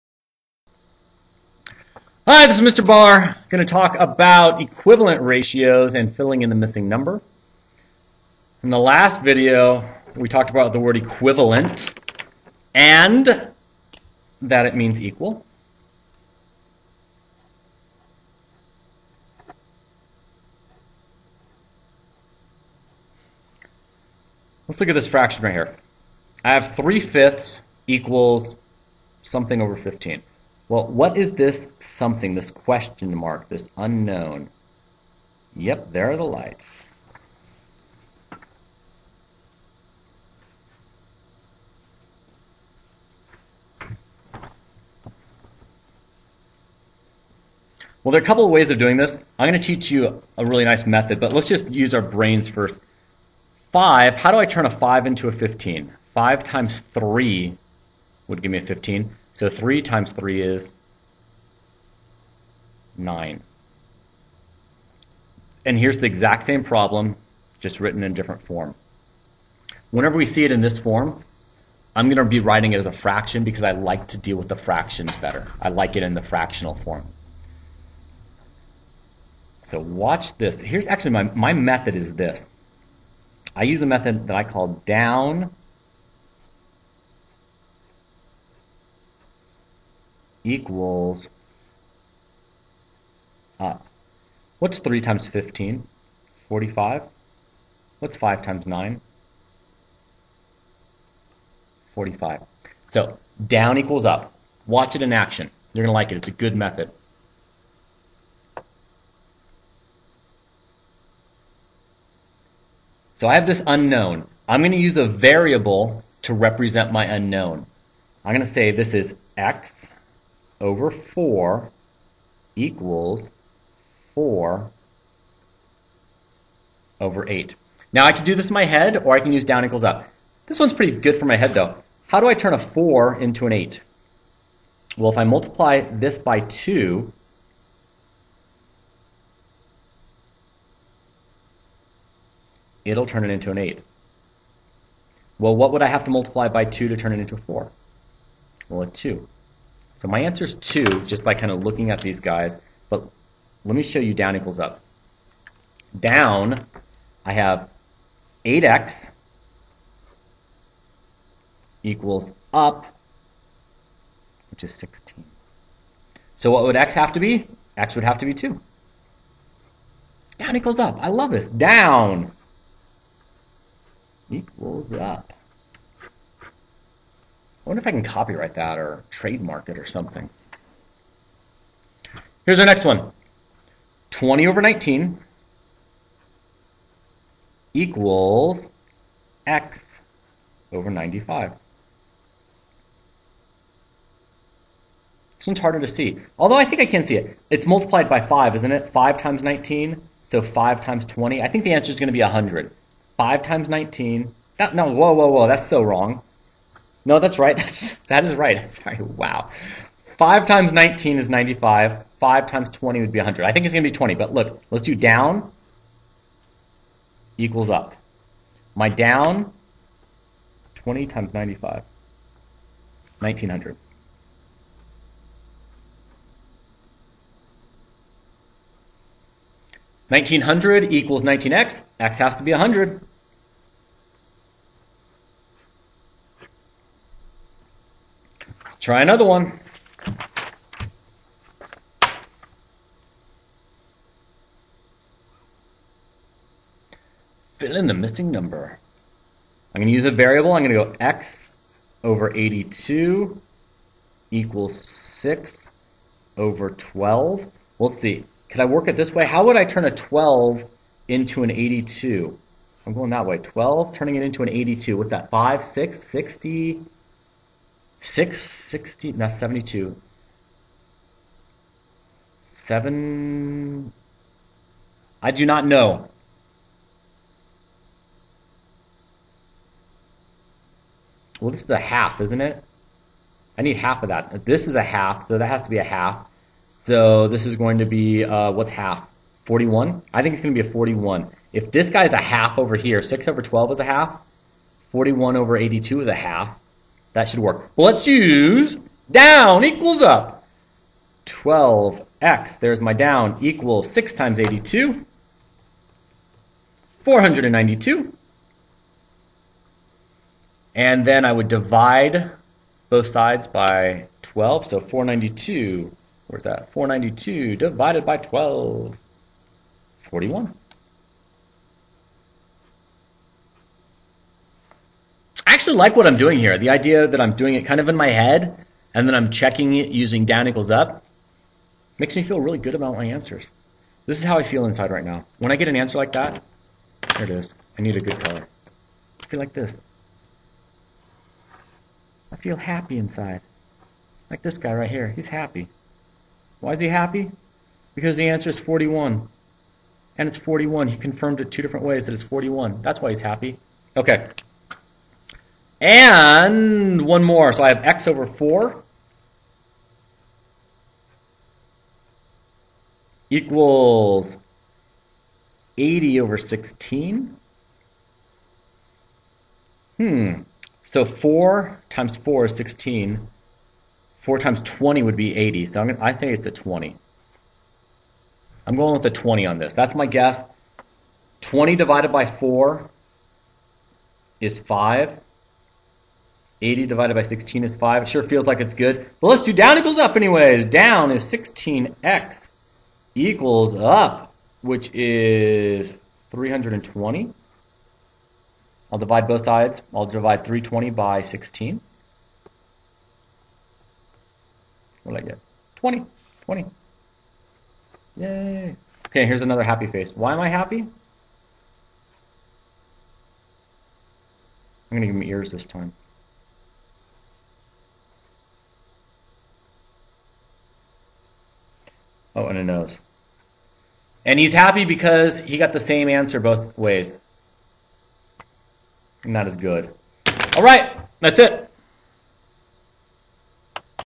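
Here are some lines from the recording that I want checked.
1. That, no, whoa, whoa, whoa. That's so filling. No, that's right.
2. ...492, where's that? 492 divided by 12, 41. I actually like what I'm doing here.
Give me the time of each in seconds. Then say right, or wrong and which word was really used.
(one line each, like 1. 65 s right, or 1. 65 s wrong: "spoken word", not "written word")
1. 204 s wrong: "wrong", not "filling"
2. 314 s right.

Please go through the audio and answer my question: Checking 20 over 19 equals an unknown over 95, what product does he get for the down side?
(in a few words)
1900.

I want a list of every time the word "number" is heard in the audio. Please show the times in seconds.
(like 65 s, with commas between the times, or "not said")
6 s, 248 s.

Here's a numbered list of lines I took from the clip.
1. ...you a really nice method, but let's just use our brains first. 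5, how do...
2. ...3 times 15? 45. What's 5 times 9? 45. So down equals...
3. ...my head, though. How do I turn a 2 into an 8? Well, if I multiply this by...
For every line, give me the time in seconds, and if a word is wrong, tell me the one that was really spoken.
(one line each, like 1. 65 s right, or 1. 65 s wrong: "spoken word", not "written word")
1. 49 s right
2. 94 s right
3. 131 s wrong: "4", not "2".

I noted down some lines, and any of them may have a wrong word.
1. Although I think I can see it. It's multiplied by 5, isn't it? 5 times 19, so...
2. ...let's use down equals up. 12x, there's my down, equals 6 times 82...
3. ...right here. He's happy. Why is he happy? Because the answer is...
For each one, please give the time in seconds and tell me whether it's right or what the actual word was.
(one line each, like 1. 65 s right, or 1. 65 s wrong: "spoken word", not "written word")
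1. 196 s right
2. 297 s right
3. 344 s right.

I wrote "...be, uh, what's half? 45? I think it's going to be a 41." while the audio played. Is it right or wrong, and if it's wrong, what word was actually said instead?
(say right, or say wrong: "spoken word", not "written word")
wrong: "41", not "45".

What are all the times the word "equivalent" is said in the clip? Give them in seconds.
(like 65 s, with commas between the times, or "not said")
4 s, 10 s.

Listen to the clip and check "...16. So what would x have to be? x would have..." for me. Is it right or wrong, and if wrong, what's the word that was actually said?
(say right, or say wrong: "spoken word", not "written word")
right.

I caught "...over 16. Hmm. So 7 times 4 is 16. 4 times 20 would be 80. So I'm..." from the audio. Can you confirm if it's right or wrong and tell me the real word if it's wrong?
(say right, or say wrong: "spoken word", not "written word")
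wrong: "4", not "7".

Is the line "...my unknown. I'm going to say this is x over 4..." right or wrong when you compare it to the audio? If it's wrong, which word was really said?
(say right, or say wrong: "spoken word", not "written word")
right.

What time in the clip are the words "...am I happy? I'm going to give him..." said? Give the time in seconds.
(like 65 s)
410 s.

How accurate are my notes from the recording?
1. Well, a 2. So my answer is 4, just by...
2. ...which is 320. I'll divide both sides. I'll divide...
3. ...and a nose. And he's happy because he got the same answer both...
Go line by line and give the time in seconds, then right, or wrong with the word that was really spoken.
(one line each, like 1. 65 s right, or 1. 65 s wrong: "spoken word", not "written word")
1. 148 s wrong: "2", not "4"
2. 394 s right
3. 422 s right.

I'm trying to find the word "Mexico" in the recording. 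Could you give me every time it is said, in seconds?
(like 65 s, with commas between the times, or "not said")
not said.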